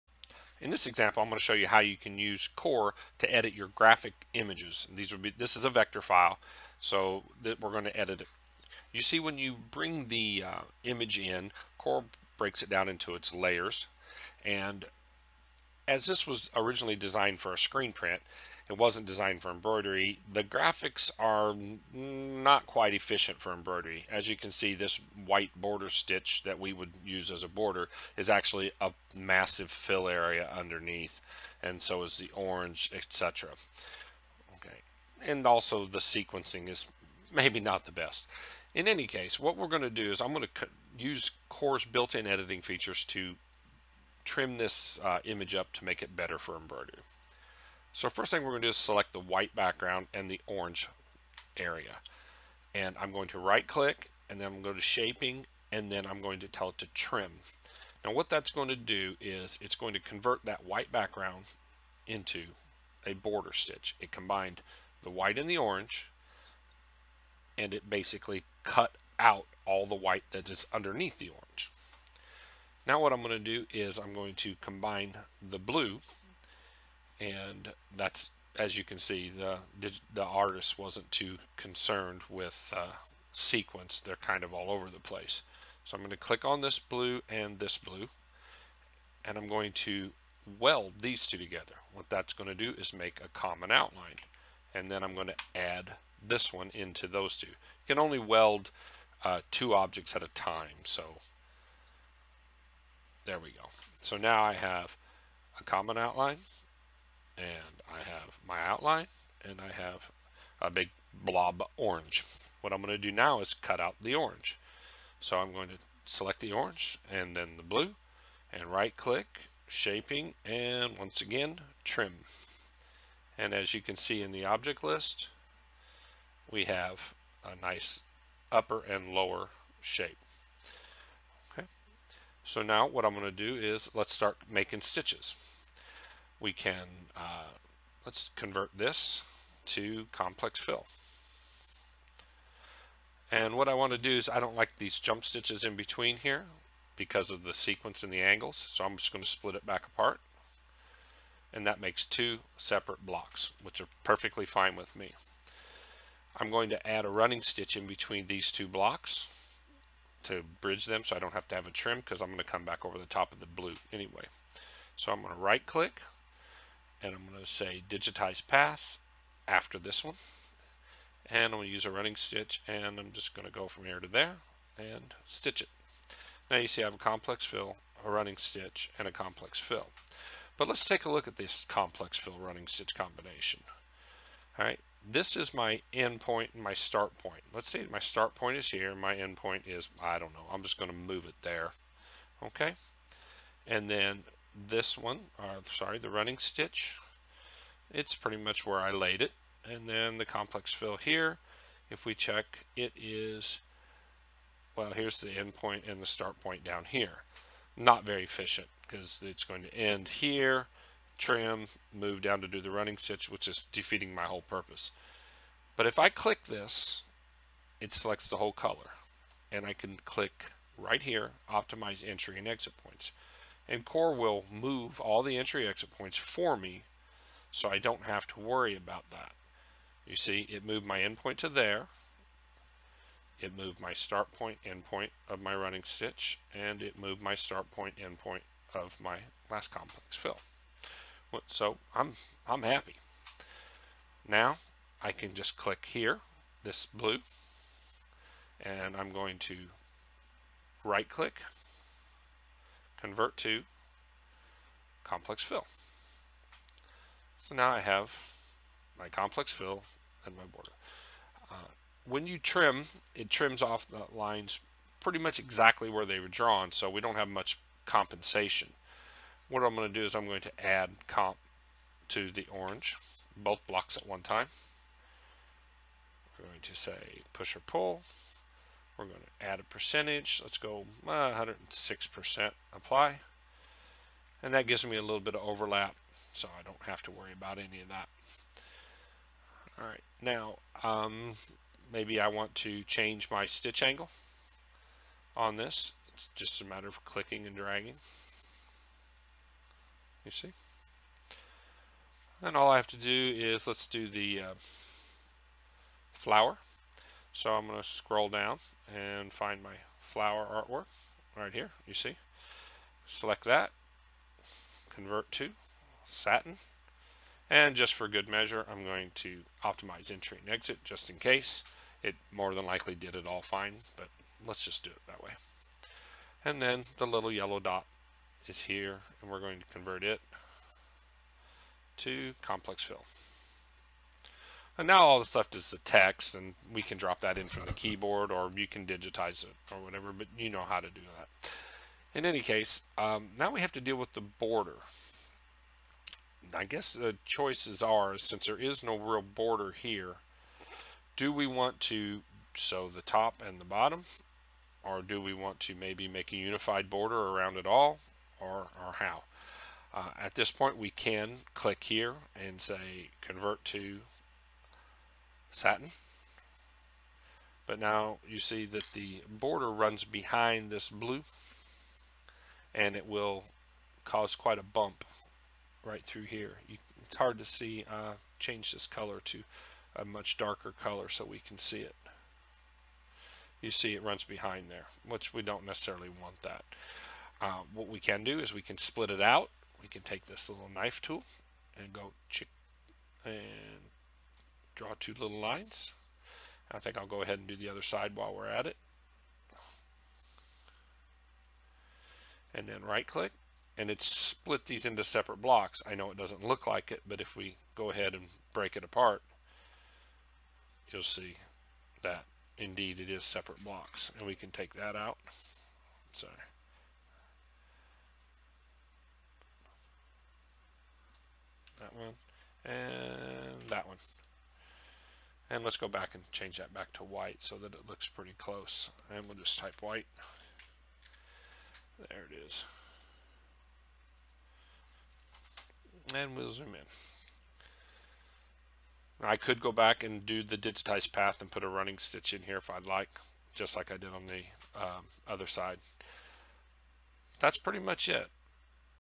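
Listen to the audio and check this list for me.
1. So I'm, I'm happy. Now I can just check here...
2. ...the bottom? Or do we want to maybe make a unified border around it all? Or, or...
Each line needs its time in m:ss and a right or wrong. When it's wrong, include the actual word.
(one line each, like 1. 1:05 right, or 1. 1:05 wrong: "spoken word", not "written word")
1. 4:01 wrong: "click", not "check"
2. 5:53 right.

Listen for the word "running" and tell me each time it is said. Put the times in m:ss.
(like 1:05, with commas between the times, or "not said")
2:37, 2:51, 2:58, 3:02, 3:16, 3:32, 3:55, 7:21.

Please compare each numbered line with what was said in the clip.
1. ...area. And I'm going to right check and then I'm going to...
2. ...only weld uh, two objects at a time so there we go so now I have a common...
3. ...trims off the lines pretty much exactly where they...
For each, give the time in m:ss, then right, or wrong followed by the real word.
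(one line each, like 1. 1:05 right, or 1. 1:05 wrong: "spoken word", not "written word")
1. 0:51 wrong: "click", not "check"
2. 1:37 right
3. 4:23 right.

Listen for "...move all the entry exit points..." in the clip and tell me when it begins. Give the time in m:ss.
3:44.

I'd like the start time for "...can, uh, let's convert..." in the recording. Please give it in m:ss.
2:16.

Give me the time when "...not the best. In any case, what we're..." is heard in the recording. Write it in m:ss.
0:37.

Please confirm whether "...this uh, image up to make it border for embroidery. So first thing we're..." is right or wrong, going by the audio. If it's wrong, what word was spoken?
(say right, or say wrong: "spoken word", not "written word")
wrong: "better", not "border".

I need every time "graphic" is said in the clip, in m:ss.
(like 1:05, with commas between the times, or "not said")
0:03, 0:20.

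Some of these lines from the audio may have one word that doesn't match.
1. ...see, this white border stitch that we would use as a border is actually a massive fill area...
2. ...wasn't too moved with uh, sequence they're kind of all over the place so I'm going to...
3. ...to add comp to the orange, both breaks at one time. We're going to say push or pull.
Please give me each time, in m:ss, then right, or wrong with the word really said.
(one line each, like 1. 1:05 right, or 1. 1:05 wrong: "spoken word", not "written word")
1. 0:24 right
2. 1:20 wrong: "concerned", not "moved"
3. 4:30 wrong: "blocks", not "breaks".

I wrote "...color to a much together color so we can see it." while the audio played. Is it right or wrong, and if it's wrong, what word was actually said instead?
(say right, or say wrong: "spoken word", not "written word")
wrong: "darker", not "together".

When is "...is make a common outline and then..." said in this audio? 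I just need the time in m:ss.
1:32.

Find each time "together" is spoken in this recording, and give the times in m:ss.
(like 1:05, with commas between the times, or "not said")
1:31.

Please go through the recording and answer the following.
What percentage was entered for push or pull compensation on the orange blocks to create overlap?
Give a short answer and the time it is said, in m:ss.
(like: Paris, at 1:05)
106%, at 4:41.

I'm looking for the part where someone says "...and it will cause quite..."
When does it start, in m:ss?
6:12.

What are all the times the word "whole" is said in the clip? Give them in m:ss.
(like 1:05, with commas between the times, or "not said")
3:34, 3:38.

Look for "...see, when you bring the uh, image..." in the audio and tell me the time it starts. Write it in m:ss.
0:09.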